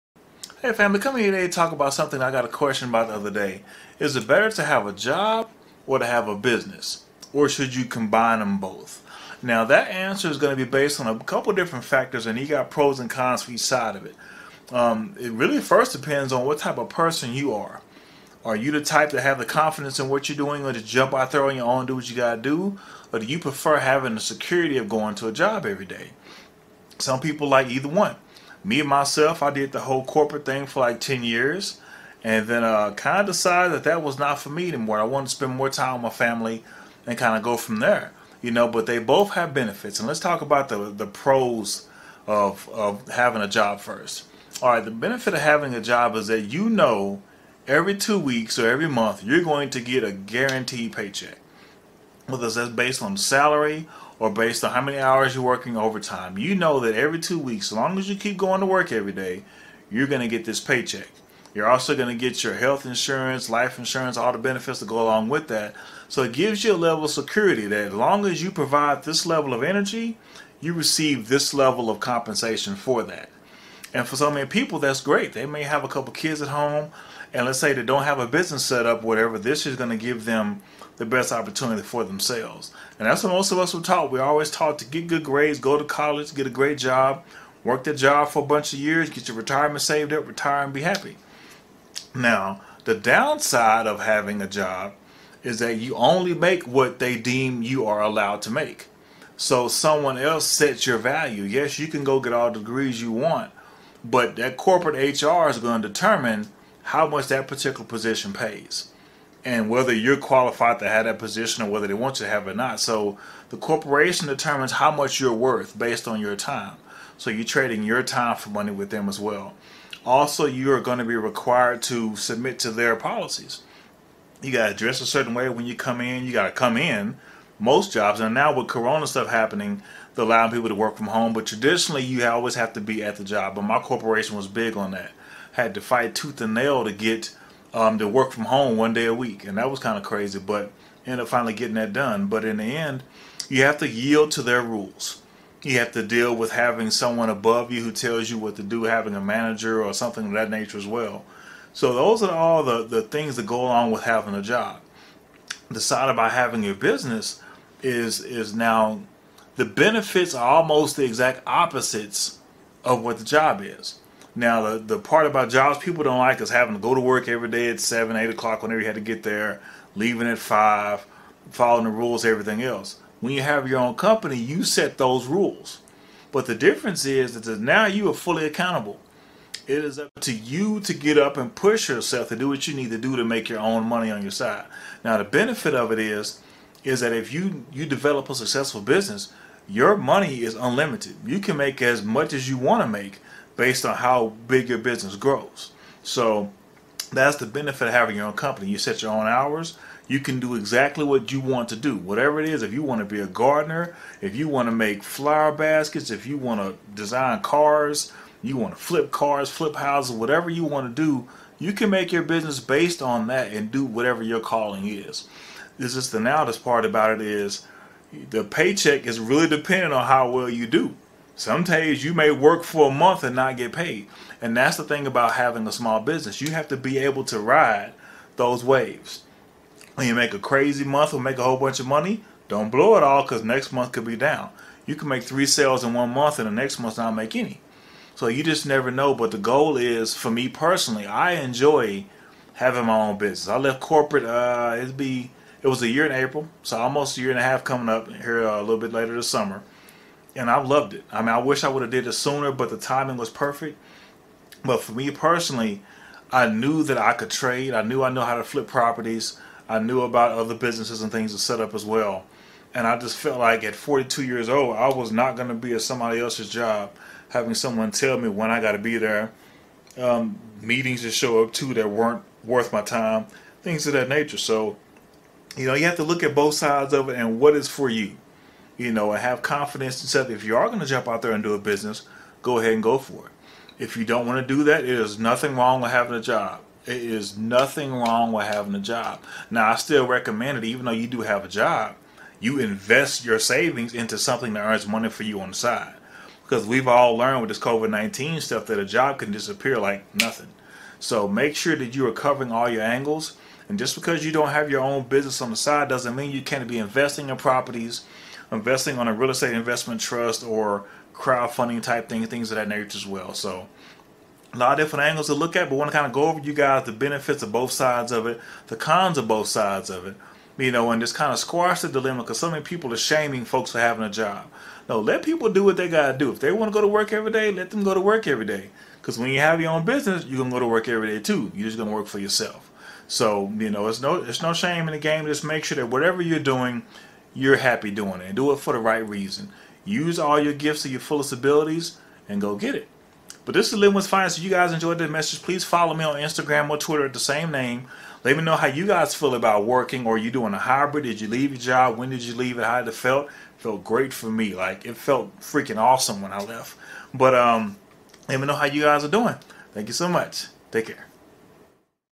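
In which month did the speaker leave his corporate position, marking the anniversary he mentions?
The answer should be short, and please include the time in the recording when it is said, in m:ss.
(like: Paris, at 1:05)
April, at 4:06.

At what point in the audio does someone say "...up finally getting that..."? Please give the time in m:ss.
2:21.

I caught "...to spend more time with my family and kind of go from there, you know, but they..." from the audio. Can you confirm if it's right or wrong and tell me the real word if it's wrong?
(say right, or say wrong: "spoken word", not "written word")
right.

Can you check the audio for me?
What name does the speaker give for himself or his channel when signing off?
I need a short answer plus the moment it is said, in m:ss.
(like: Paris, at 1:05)
Lynwood's Finest, at 5:43.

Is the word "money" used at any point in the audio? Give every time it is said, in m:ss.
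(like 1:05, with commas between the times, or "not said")
1:58, 3:03, 3:09, 3:51, 4:54.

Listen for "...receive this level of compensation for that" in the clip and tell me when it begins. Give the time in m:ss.
1:10.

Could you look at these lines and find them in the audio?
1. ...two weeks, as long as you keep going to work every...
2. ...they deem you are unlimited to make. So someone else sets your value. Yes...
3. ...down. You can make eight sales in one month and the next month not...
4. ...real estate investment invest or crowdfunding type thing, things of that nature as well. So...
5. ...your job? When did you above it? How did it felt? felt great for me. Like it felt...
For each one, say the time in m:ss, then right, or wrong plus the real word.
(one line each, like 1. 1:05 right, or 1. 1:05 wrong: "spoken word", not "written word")
1. 0:57 right
2. 1:36 wrong: "allowed", not "unlimited"
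3. 3:54 wrong: "three", not "eight"
4. 5:09 wrong: "trust", not "invest"
5. 5:51 wrong: "leave", not "above".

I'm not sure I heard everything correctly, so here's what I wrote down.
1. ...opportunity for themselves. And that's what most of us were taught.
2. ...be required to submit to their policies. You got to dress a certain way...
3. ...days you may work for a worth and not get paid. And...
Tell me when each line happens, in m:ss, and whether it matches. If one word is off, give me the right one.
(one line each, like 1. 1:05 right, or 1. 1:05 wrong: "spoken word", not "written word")
1. 1:21 right
2. 2:01 right
3. 3:41 wrong: "month", not "worth".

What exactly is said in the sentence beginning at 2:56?
But the difference is that now you are fully accountable.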